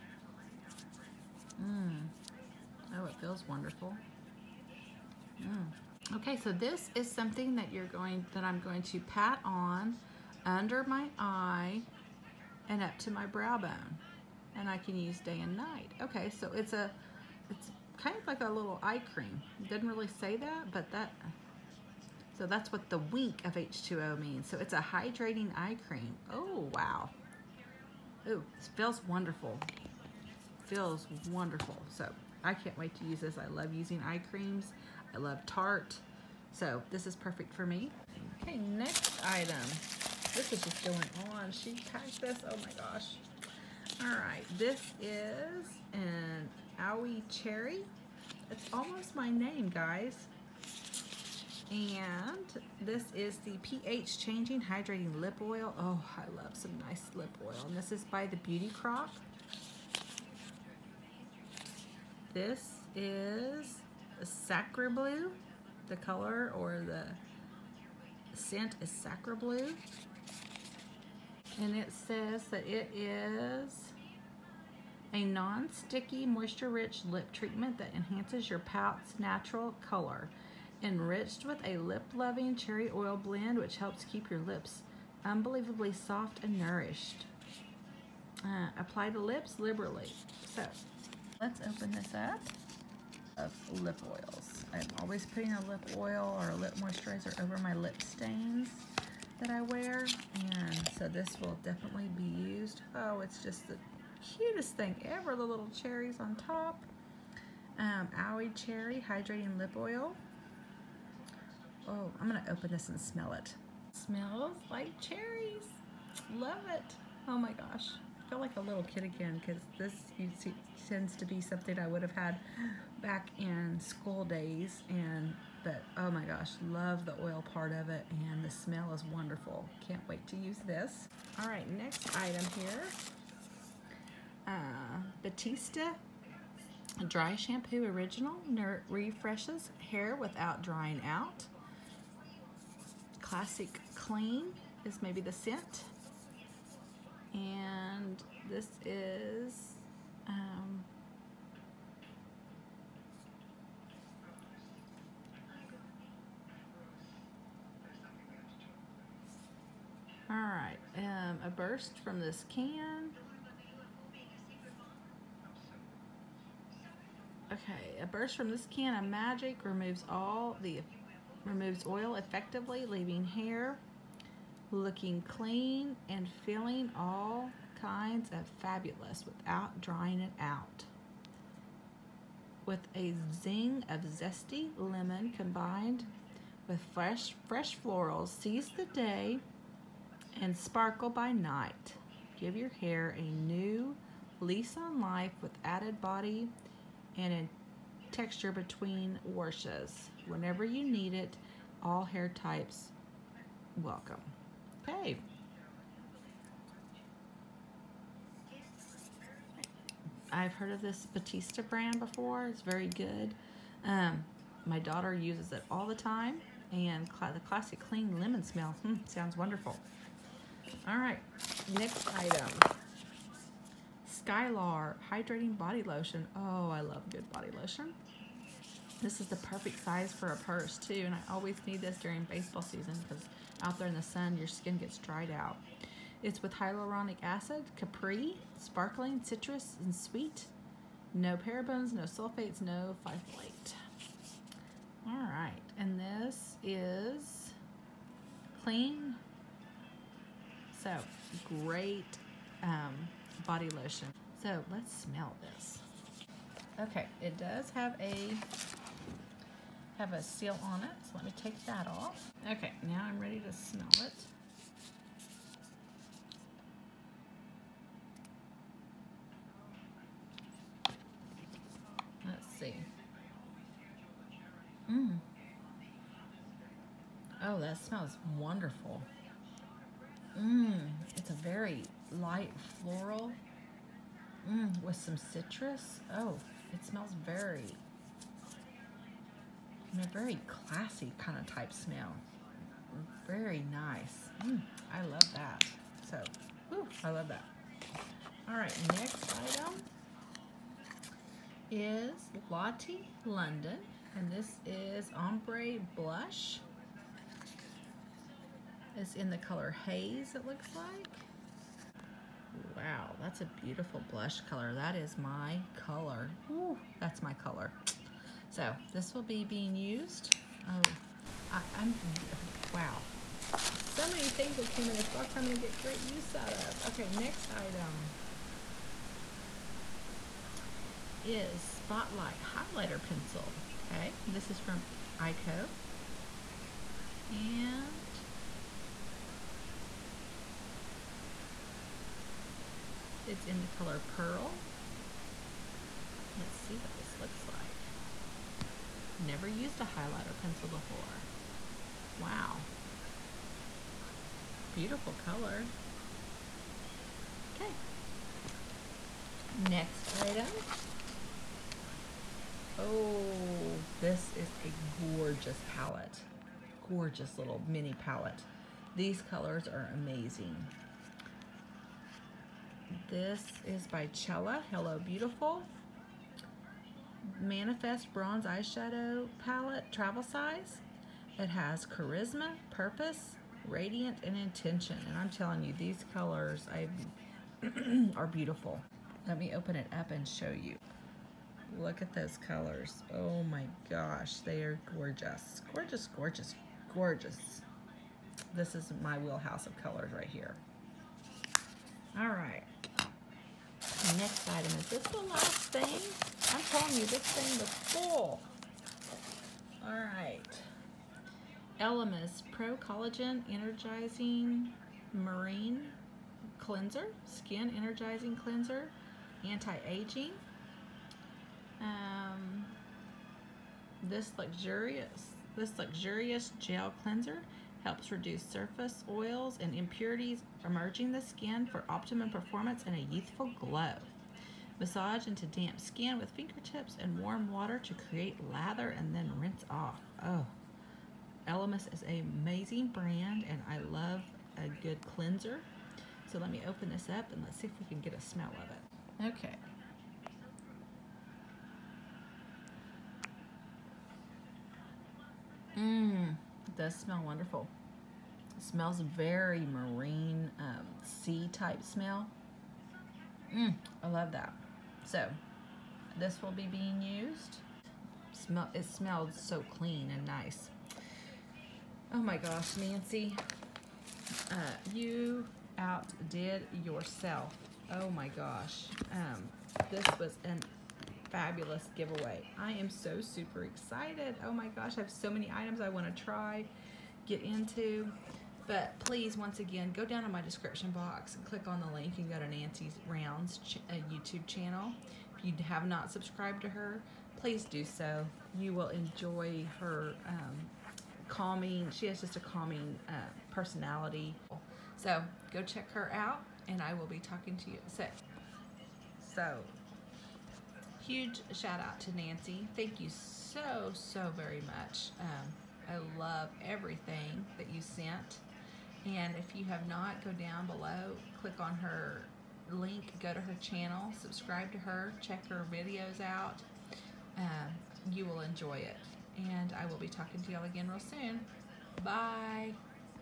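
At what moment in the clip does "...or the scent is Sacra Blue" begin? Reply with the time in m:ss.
1:06.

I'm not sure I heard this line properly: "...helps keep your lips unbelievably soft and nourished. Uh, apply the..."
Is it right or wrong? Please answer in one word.
right.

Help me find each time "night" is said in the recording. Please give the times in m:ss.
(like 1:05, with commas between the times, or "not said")
0:15, 3:11.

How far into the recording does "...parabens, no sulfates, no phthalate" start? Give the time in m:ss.
4:01.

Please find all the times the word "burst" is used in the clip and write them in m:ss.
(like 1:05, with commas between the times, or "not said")
2:41, 2:48.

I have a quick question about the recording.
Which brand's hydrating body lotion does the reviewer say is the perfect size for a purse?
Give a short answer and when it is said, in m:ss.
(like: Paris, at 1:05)
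Skylar, at 3:44.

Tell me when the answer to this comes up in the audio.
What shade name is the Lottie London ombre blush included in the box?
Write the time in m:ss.
5:09.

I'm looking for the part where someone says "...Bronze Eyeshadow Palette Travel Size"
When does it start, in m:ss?
6:18.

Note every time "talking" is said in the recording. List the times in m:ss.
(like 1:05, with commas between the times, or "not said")
8:27, 8:50.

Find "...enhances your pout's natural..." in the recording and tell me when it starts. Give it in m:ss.
1:17.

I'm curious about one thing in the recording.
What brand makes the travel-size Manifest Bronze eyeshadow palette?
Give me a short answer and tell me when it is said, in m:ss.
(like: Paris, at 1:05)
Cella, at 6:14.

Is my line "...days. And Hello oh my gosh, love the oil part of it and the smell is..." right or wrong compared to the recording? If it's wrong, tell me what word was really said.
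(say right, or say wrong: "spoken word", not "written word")
wrong: "But", not "Hello".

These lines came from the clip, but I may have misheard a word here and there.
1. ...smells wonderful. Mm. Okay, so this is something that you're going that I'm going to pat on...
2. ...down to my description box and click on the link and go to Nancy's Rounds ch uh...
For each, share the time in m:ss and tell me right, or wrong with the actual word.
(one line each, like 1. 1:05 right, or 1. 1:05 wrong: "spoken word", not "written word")
1. 0:03 wrong: "feels", not "smells"
2. 8:10 right.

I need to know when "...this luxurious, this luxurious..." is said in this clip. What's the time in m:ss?
7:04.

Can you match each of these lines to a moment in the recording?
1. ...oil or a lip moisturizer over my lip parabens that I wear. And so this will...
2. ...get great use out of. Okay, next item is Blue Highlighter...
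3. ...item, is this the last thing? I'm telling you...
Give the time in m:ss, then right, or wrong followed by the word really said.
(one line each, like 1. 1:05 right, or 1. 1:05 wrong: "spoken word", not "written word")
1. 1:35 wrong: "stains", not "parabens"
2. 5:25 wrong: "Spotlight", not "Blue"
3. 6:44 right.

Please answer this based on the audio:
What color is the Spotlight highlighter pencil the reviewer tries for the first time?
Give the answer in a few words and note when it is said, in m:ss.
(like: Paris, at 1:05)
Pearl, at 5:44.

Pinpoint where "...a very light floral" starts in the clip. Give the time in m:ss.
4:41.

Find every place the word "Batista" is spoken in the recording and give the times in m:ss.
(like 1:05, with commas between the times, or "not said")
2:15, 3:31.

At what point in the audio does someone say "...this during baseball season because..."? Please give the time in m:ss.
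3:51.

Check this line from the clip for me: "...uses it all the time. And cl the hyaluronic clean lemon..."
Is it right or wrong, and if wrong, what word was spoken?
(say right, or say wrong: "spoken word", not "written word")
wrong: "classic", not "hyaluronic".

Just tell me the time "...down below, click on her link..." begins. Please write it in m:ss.
8:40.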